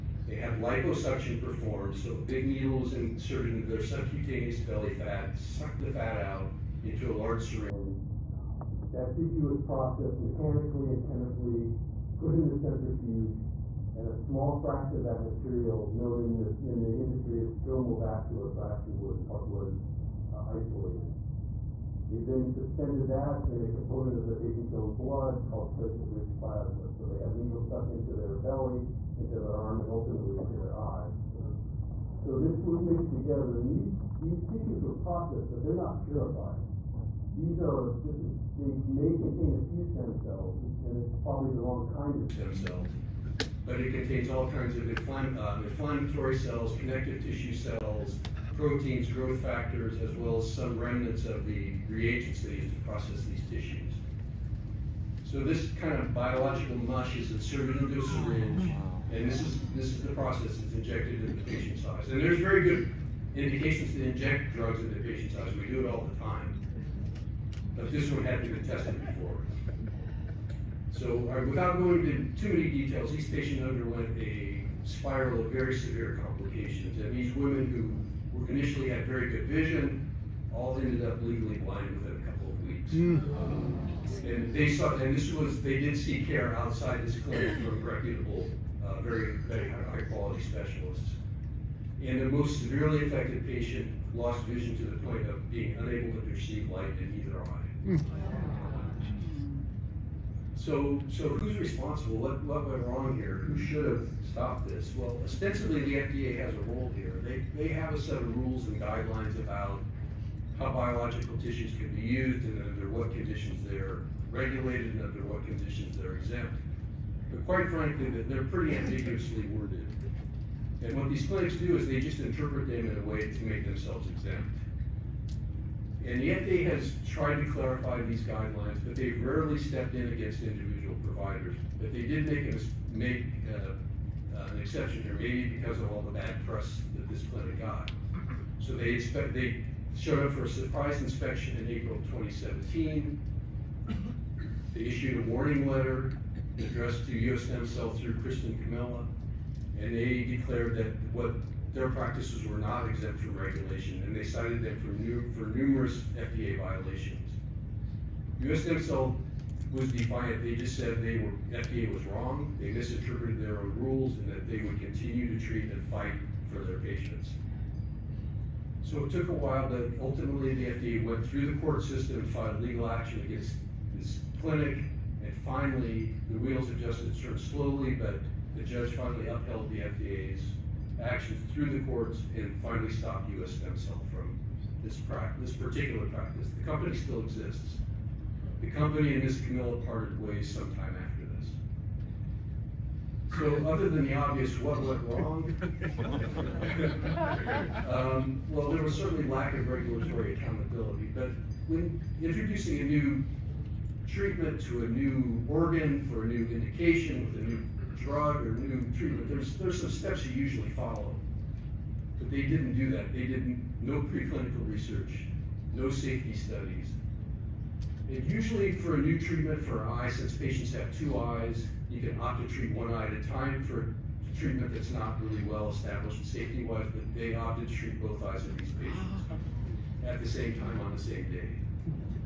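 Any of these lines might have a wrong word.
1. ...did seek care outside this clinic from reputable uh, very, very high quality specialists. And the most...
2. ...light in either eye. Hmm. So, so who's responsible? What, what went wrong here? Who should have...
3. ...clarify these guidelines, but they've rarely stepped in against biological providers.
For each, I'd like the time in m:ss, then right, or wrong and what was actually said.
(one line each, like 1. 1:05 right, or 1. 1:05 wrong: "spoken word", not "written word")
1. 1:25 right
2. 1:36 right
3. 2:07 wrong: "individual", not "biological".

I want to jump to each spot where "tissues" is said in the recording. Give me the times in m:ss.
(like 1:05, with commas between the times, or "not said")
0:09, 0:34, 0:47, 0:53, 1:51.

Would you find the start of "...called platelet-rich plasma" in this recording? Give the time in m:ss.
0:25.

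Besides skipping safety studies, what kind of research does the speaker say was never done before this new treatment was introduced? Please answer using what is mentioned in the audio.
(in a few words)
Preclinical research.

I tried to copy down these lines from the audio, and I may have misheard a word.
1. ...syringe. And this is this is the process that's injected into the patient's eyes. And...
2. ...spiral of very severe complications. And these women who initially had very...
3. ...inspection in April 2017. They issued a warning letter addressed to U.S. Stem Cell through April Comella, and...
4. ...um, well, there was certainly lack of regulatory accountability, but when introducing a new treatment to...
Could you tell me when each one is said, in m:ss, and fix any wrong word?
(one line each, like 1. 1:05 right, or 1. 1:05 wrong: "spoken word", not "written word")
1. 0:58 right
2. 1:14 right
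3. 2:21 wrong: "Kristin", not "April"
4. 3:17 right.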